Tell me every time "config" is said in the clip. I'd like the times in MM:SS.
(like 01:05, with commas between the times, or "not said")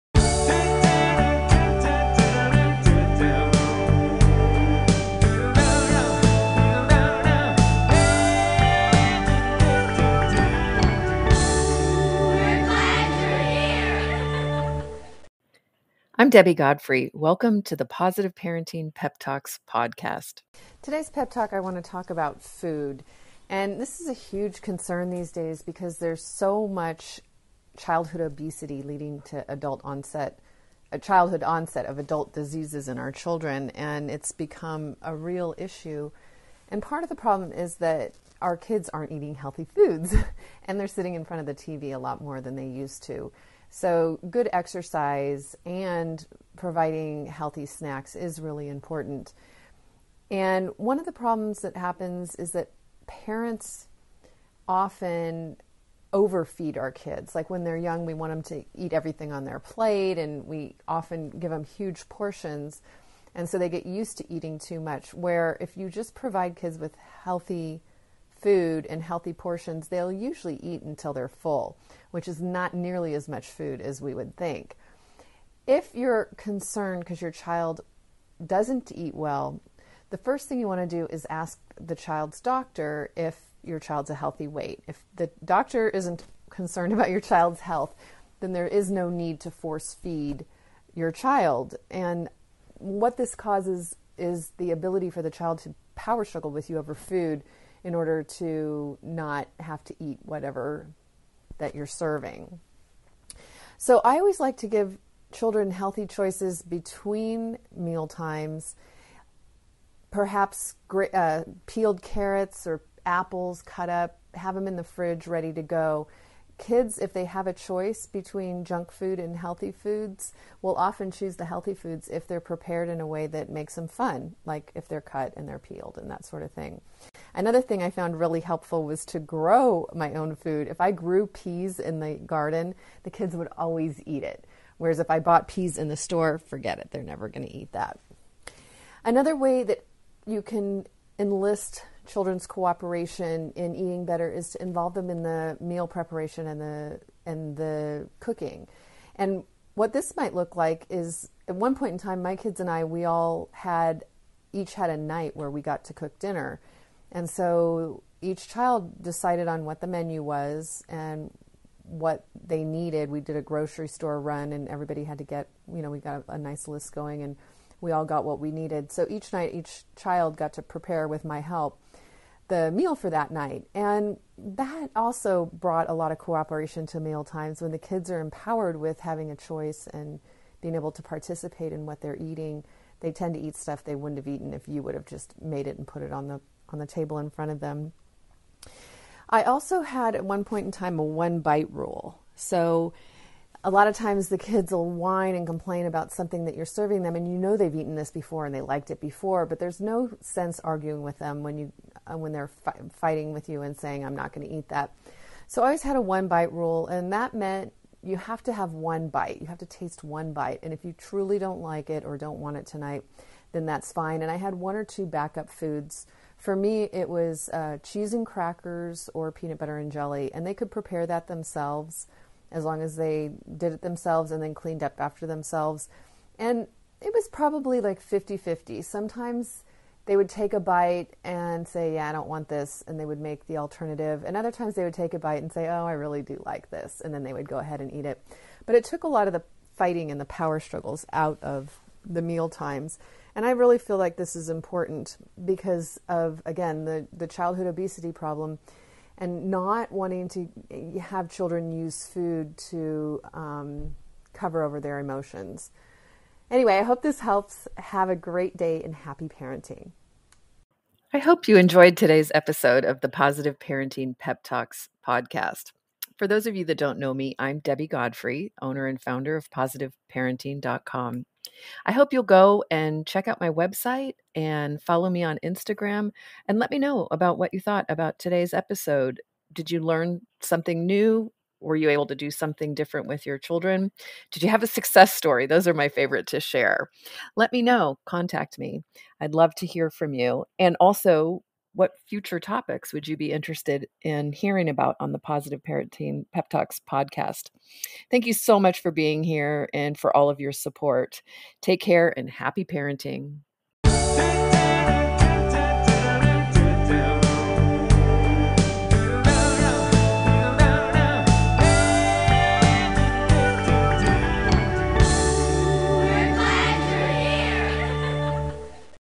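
not said.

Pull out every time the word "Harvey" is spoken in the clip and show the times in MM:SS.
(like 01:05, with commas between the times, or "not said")
not said.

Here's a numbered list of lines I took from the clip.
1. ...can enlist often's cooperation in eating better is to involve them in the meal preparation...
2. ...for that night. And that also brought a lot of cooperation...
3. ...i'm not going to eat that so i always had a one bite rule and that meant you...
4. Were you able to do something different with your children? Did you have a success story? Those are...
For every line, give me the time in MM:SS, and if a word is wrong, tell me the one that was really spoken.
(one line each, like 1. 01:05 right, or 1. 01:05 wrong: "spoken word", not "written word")
1. 02:20 wrong: "children", not "often"
2. 02:52 right
3. 03:24 right
4. 04:41 right.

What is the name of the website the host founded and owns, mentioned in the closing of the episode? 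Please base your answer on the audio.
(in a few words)
positiveparenting.com.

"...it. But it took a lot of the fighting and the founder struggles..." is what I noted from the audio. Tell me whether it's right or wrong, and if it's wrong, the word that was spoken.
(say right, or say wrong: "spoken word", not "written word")
wrong: "power", not "founder".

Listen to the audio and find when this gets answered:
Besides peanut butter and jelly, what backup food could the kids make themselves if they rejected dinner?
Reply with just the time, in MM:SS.
03:37.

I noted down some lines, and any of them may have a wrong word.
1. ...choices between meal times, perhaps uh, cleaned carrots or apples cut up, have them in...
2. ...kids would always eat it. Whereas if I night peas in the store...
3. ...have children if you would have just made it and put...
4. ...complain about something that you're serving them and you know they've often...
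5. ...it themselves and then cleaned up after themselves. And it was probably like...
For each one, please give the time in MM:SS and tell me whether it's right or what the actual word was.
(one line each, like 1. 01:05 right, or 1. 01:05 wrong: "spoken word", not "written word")
1. 01:46 wrong: "peeled", not "cleaned"
2. 02:13 wrong: "bought", not "night"
3. 03:04 wrong: "eaten", not "children"
4. 03:15 wrong: "eaten", not "often"
5. 03:43 right.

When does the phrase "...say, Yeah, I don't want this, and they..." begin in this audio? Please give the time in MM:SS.
03:51.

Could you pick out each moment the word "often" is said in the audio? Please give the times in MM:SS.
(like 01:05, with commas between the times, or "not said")
00:54, 01:00, 02:00.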